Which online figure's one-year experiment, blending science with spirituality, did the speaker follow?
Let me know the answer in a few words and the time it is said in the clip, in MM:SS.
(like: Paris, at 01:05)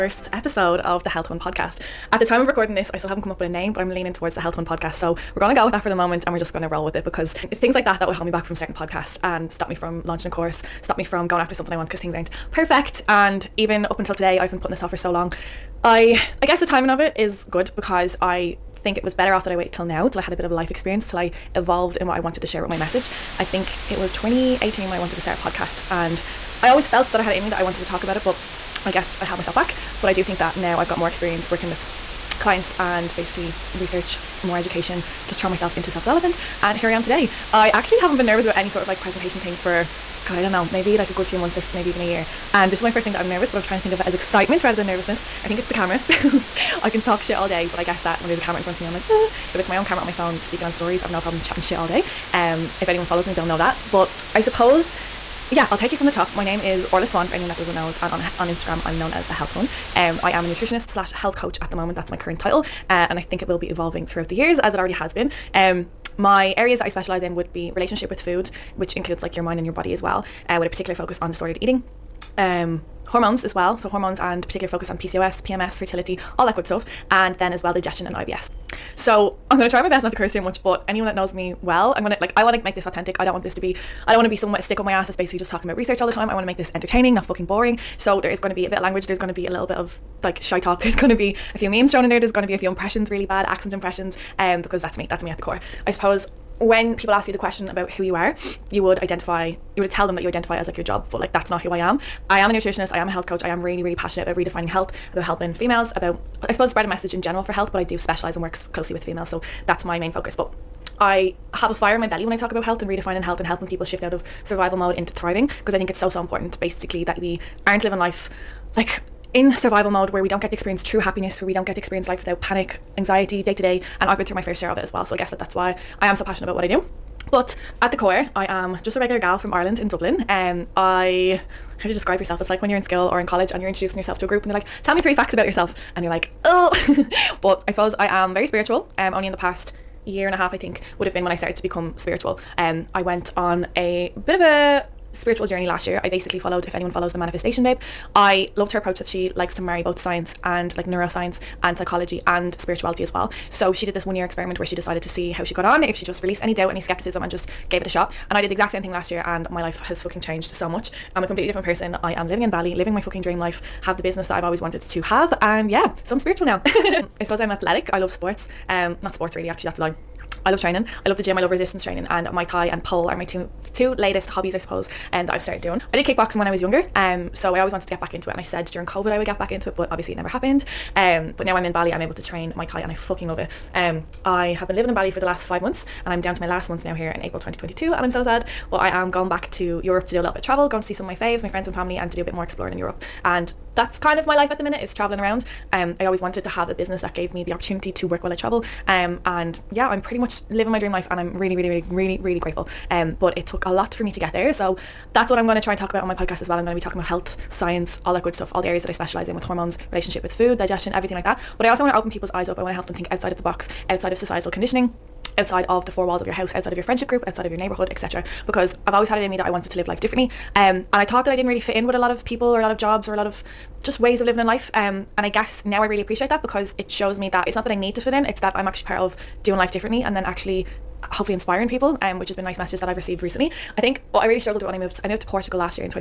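Manifestation Babe, at 02:27.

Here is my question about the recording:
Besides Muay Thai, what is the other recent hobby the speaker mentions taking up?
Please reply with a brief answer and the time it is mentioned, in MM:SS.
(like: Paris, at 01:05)
Pole, at 02:52.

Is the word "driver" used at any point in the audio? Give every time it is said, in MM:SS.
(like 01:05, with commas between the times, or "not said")
not said.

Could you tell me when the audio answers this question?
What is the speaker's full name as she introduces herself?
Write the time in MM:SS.
00:56.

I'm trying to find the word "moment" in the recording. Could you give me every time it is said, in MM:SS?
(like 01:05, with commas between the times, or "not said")
00:05, 01:01.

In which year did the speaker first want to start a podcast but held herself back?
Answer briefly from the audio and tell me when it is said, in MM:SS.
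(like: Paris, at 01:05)
2018, at 00:24.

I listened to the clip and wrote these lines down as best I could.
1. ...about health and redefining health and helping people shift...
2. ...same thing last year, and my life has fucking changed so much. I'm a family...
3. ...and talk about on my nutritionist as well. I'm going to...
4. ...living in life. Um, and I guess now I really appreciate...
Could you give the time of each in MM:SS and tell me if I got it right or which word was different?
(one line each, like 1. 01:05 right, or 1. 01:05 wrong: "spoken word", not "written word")
1. 01:52 right
2. 02:38 wrong: "completely", not "family"
3. 03:25 wrong: "podcast", not "nutritionist"
4. 03:44 right.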